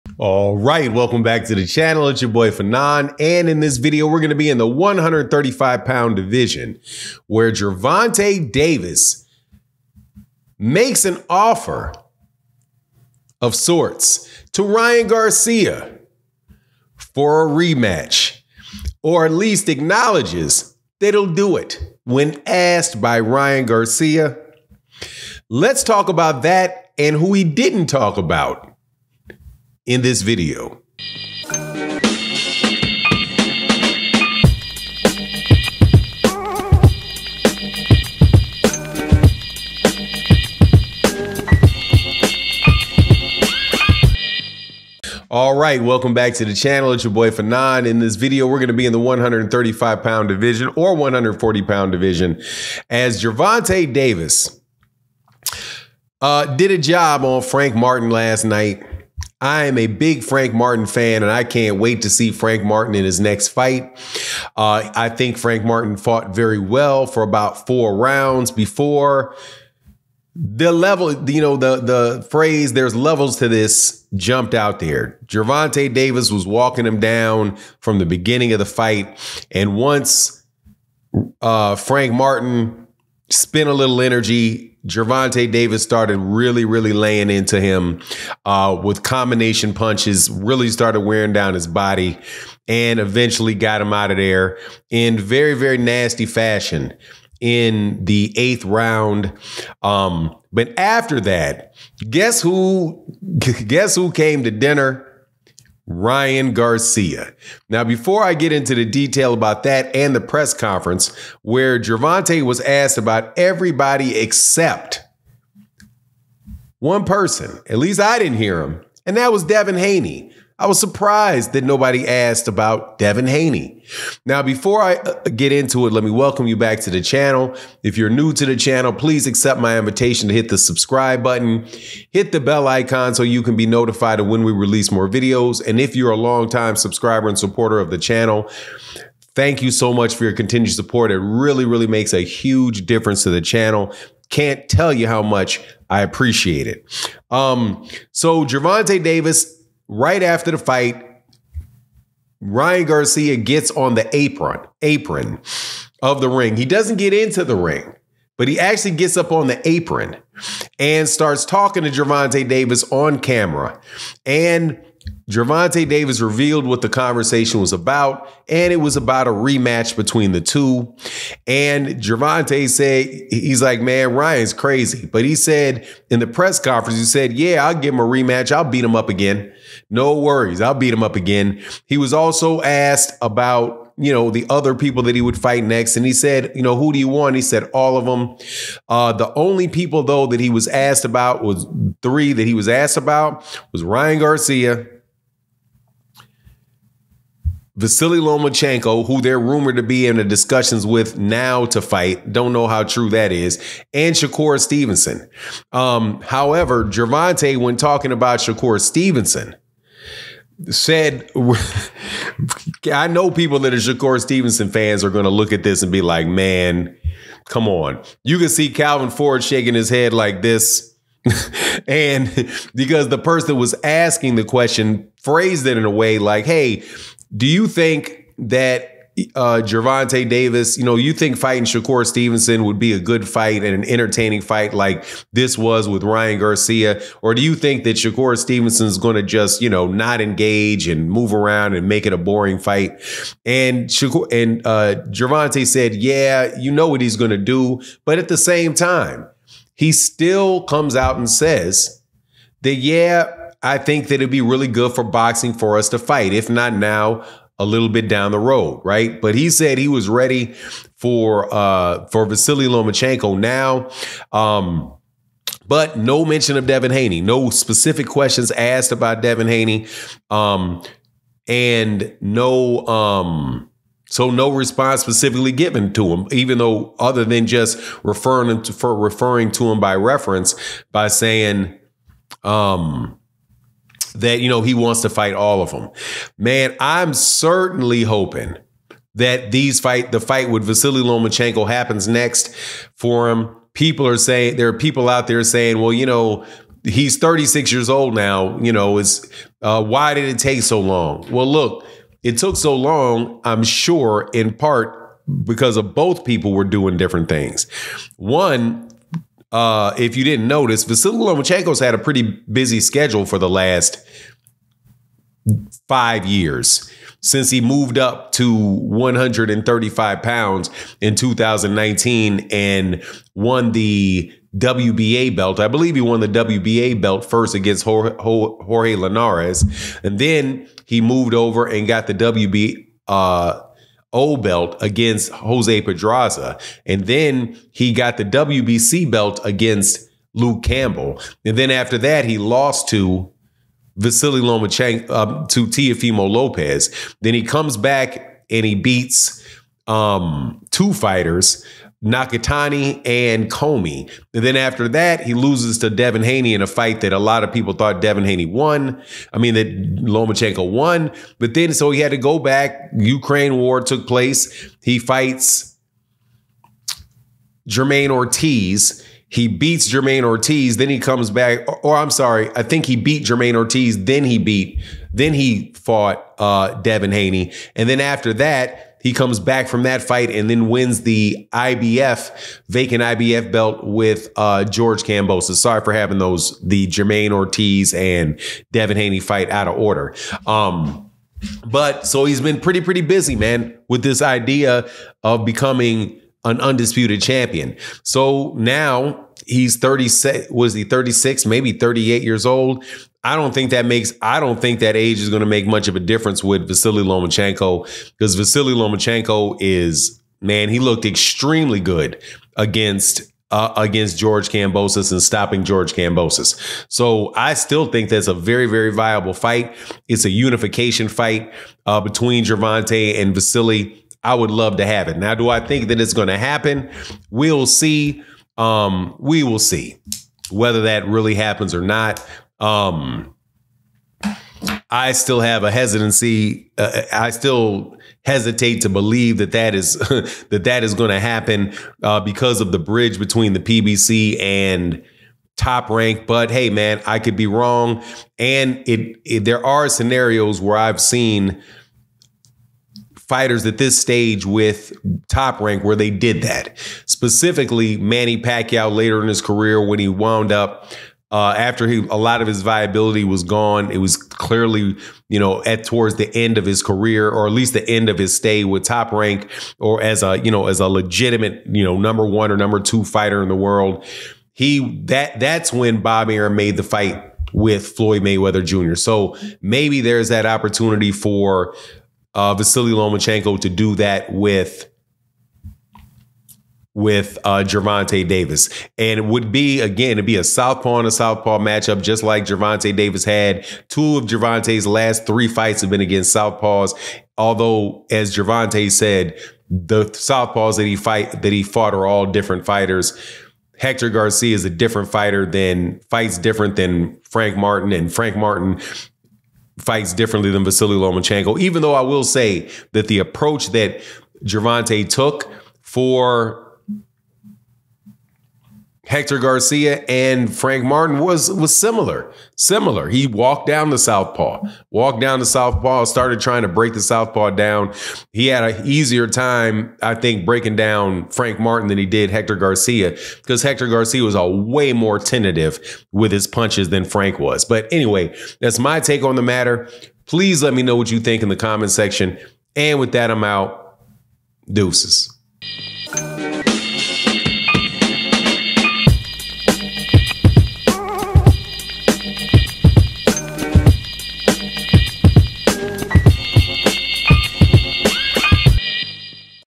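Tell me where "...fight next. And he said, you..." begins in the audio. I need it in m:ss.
3:05.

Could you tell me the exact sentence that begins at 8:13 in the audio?
Two of Gervonta's last three fights have been against southpaws.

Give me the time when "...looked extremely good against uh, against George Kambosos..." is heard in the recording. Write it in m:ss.
6:50.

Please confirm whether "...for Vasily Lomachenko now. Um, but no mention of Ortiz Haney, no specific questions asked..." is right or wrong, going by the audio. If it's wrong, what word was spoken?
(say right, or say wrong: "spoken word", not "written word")
wrong: "Devin", not "Ortiz".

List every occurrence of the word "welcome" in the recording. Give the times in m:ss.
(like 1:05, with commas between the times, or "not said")
0:00, 0:45, 2:06.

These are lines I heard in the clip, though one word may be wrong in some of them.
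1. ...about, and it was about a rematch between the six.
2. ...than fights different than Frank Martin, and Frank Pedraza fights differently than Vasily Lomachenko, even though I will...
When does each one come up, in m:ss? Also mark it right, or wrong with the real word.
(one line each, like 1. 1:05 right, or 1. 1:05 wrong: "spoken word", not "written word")
1. 2:47 wrong: "two", not "six"
2. 8:25 wrong: "Martin", not "Pedraza".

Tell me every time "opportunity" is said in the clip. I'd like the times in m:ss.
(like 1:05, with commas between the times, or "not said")
8:00.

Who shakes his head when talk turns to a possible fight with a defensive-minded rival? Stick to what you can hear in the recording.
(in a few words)
Calvin Ford.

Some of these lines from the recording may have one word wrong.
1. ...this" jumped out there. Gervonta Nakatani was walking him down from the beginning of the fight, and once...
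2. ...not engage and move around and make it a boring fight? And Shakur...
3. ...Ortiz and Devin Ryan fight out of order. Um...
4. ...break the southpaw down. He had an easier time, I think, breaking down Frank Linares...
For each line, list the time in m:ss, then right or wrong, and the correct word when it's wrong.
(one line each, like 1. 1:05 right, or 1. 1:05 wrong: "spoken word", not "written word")
1. 1:13 wrong: "Davis", not "Nakatani"
2. 3:59 right
3. 6:27 wrong: "Haney", not "Ryan"
4. 8:46 wrong: "Martin", not "Linares".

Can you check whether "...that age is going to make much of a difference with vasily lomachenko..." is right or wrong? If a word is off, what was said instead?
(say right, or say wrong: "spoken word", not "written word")
right.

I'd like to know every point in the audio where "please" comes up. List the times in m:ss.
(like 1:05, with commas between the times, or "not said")
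2:08, 9:00.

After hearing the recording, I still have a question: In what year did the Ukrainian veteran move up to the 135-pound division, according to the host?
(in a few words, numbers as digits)
2019.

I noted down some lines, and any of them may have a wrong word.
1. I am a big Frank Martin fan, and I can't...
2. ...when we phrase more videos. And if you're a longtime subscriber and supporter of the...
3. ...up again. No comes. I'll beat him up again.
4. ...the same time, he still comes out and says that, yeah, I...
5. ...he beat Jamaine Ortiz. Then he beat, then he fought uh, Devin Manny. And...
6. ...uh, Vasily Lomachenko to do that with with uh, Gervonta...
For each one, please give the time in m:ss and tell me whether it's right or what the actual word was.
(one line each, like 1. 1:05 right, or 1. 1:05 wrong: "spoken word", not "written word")
1. 0:59 right
2. 2:14 wrong: "release", not "phrase"
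3. 2:58 wrong: "worries", not "comes"
4. 4:08 right
5. 6:12 wrong: "Haney", not "Manny"
6. 8:02 right.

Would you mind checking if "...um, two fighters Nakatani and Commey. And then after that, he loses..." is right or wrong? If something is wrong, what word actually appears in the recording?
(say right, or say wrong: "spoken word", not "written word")
right.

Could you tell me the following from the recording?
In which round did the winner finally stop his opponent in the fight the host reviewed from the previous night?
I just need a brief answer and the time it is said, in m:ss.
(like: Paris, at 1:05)
Eighth round, at 1:38.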